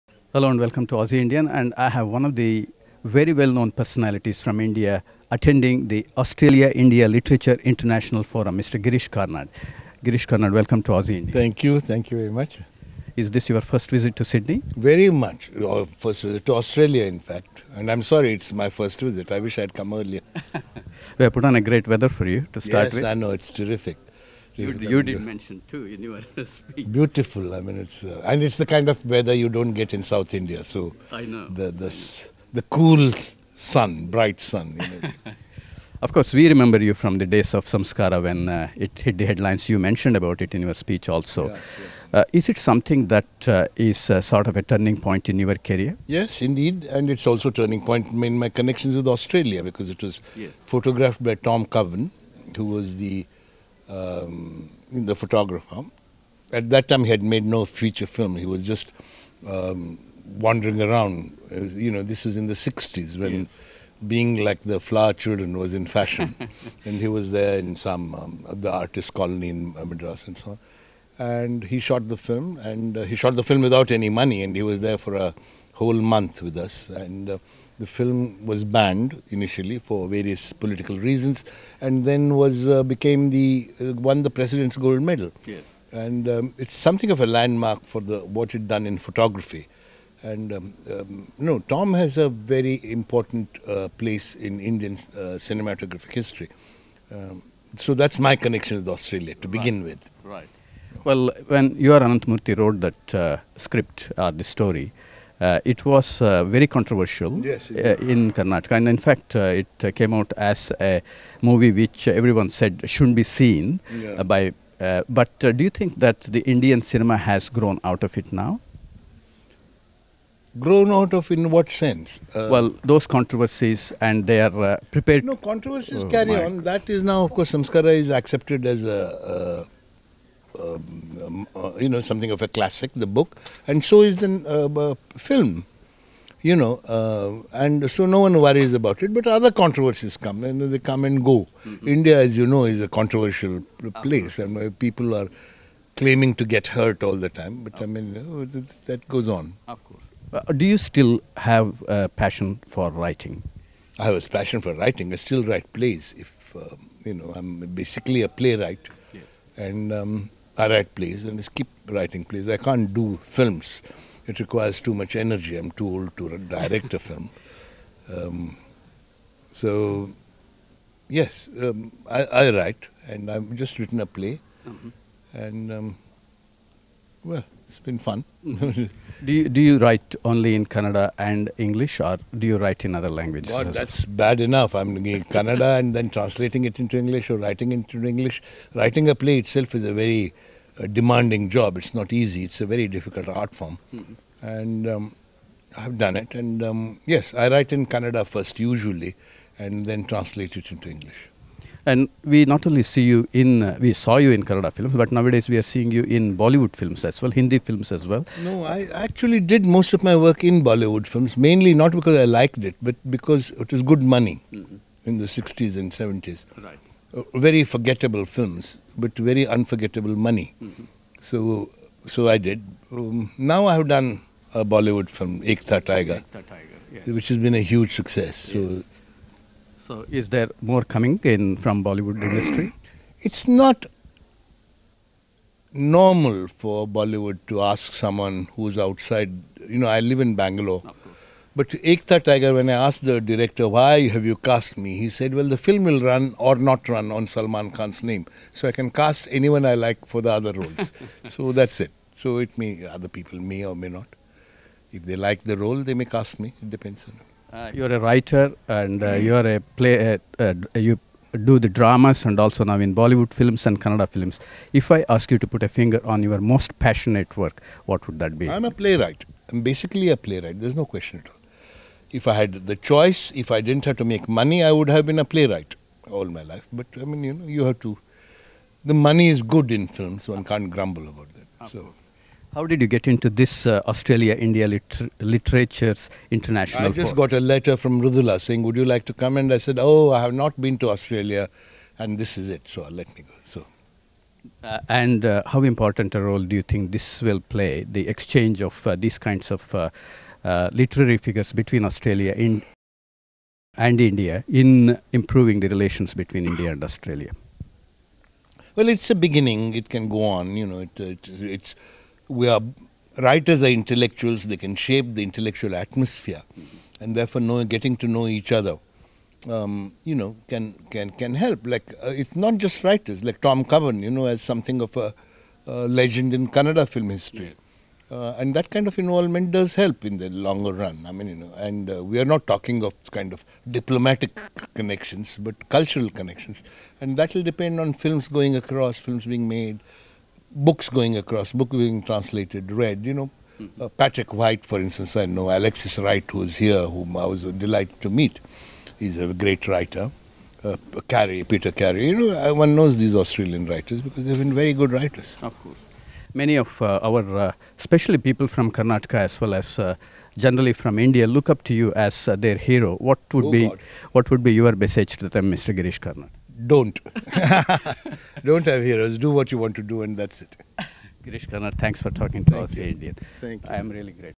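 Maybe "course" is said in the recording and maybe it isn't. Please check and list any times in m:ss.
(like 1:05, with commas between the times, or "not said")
0:36, 2:07, 2:29, 5:55.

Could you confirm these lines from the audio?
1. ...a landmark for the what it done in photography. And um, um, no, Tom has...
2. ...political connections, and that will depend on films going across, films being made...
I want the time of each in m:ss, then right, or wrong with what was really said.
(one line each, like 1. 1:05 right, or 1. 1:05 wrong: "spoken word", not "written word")
1. 1:27 right
2. 5:35 wrong: "cultural", not "political".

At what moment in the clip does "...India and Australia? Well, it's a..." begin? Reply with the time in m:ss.
5:06.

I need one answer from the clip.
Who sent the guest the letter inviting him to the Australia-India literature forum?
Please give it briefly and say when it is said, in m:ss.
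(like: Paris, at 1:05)
Mridula, at 4:48.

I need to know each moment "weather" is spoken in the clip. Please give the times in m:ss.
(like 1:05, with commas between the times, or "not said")
0:21, 0:29.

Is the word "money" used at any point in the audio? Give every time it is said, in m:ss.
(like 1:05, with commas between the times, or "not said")
1:14, 3:34, 3:40, 4:34, 4:38.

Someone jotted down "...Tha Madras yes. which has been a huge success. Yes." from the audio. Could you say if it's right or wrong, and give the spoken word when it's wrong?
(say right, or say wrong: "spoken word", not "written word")
wrong: "Tiger", not "Madras".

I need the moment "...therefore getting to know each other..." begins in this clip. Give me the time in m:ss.
5:17.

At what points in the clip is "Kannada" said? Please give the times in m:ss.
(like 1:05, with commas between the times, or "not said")
3:00, 3:05, 3:17, 3:24, 4:23, 5:26.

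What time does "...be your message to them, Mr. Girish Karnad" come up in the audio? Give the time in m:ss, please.
6:04.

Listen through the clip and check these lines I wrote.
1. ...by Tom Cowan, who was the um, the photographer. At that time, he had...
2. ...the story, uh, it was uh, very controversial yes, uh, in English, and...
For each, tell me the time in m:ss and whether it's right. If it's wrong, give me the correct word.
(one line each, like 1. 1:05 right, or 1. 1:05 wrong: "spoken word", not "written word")
1. 0:51 right
2. 1:44 wrong: "Karnataka", not "English".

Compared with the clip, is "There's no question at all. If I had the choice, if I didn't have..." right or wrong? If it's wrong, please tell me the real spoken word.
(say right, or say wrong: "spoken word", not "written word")
right.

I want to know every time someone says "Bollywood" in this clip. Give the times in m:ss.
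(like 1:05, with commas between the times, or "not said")
3:26, 3:30, 3:44, 3:51, 3:56, 4:22.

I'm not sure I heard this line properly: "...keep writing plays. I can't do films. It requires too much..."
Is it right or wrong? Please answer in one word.
right.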